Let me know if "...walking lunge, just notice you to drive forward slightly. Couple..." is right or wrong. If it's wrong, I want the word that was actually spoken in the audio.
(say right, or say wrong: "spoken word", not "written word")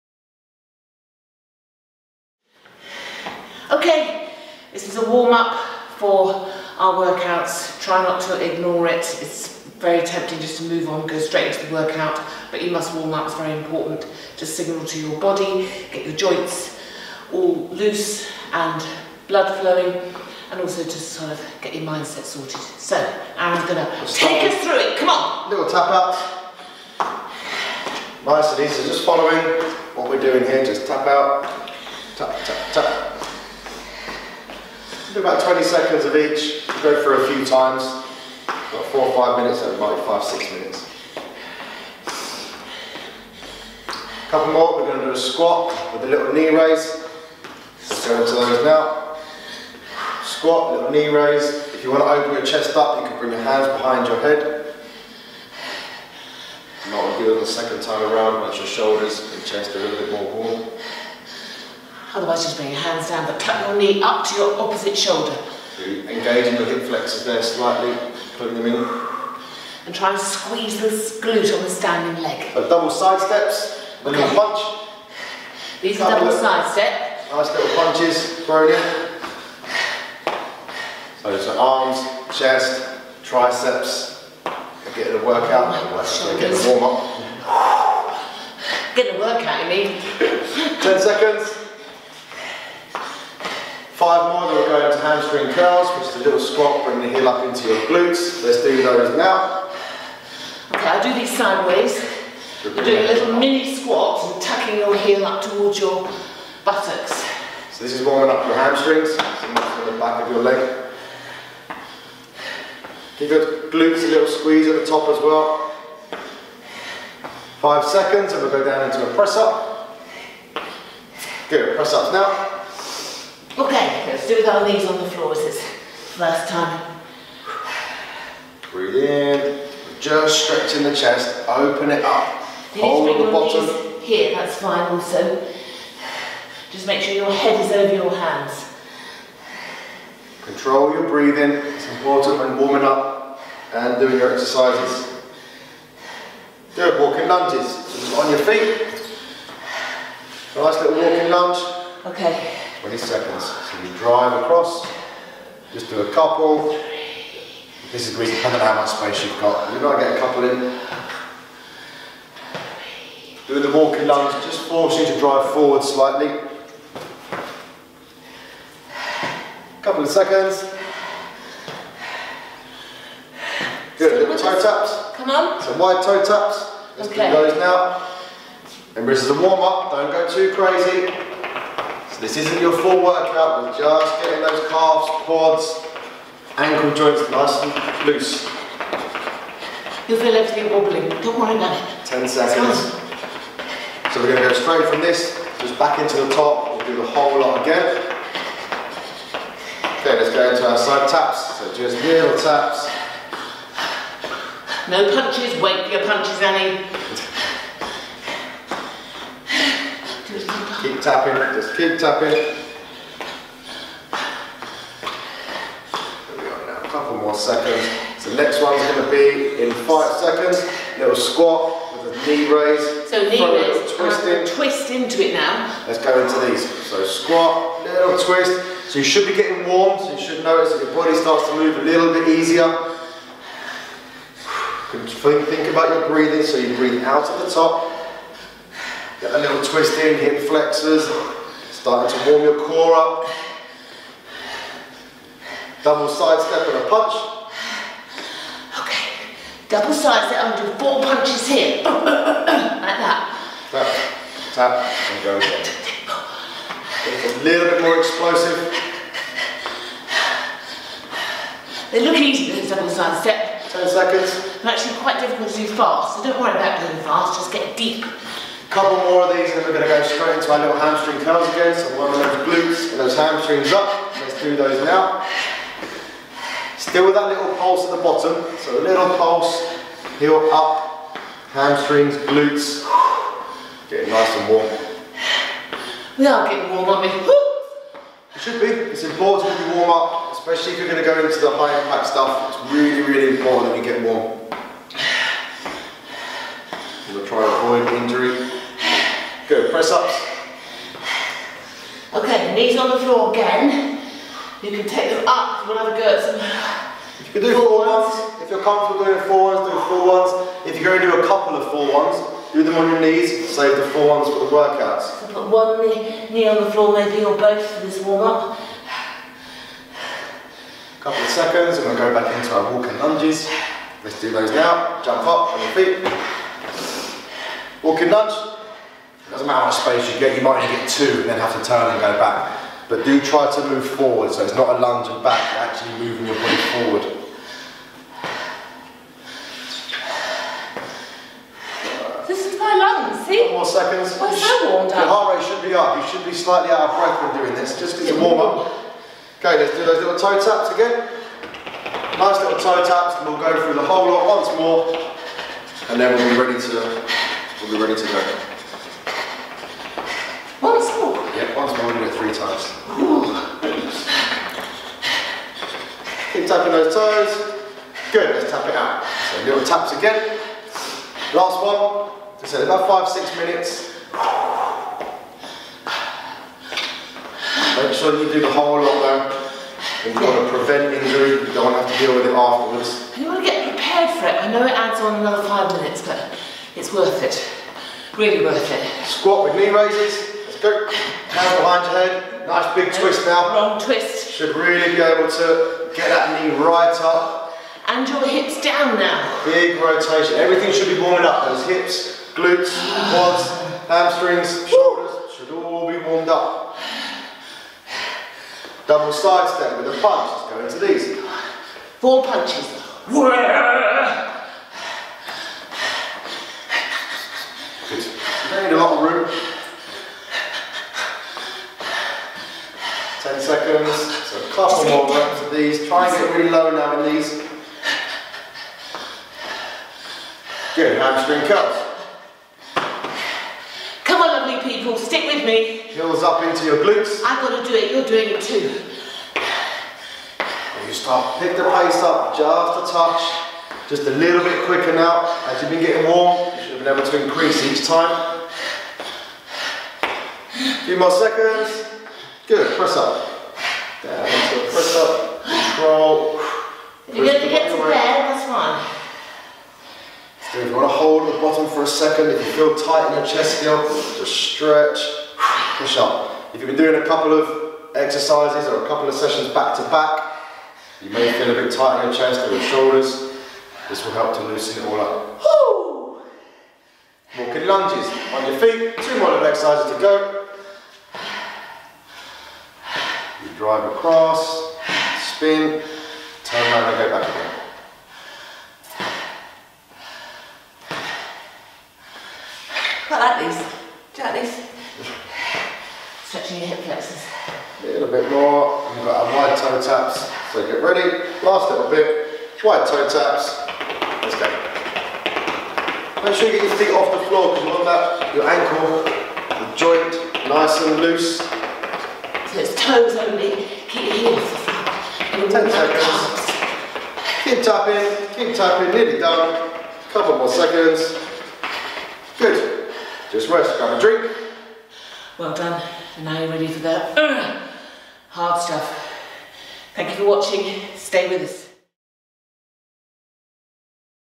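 wrong: "force", not "notice".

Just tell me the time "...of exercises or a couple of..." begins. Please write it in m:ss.
7:47.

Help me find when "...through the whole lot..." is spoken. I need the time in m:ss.
5:53.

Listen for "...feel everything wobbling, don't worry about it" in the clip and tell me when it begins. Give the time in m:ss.
3:10.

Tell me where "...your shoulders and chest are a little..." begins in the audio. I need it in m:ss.
0:58.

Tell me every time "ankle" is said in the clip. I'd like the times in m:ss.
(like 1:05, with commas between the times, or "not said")
3:06, 8:28.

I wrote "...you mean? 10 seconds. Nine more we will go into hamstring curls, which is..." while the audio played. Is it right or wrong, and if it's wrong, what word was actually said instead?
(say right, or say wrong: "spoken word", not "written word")
wrong: "Five", not "Nine".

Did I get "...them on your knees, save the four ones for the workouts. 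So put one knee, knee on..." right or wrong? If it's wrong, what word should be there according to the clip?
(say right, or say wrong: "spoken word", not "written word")
right.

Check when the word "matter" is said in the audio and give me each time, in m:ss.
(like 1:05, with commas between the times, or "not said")
5:29.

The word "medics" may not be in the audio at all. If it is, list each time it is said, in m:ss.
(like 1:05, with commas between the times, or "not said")
not said.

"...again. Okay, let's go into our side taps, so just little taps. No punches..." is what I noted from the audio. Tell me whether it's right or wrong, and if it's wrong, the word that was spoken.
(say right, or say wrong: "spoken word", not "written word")
right.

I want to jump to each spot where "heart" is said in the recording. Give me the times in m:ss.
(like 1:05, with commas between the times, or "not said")
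5:45.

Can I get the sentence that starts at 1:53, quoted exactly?
Give your glutes a little squeeze at the top as well.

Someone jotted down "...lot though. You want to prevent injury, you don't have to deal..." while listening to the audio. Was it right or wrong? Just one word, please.
right.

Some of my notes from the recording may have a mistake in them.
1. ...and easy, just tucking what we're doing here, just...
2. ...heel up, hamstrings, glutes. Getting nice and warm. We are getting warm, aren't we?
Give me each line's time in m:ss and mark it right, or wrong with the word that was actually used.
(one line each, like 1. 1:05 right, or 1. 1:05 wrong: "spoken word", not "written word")
1. 0:28 wrong: "following", not "tucking"
2. 4:40 right.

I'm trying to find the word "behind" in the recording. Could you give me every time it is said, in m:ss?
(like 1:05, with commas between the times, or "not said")
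0:53, 6:31.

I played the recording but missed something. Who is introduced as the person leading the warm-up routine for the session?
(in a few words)
Aaron.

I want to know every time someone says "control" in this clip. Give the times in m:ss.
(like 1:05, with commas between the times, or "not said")
2:20, 7:35.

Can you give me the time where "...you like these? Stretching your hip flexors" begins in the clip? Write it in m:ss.
8:14.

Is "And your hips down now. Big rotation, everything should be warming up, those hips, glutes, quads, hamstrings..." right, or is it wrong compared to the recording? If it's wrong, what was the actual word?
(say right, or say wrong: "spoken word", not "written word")
right.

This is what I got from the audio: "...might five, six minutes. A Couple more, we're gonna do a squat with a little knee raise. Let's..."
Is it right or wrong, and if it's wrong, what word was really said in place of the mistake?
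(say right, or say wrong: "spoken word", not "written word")
right.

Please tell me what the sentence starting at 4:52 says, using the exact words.
It's really, really important that you get warm.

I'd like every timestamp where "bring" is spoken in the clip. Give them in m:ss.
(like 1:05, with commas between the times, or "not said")
0:53, 1:02, 1:36.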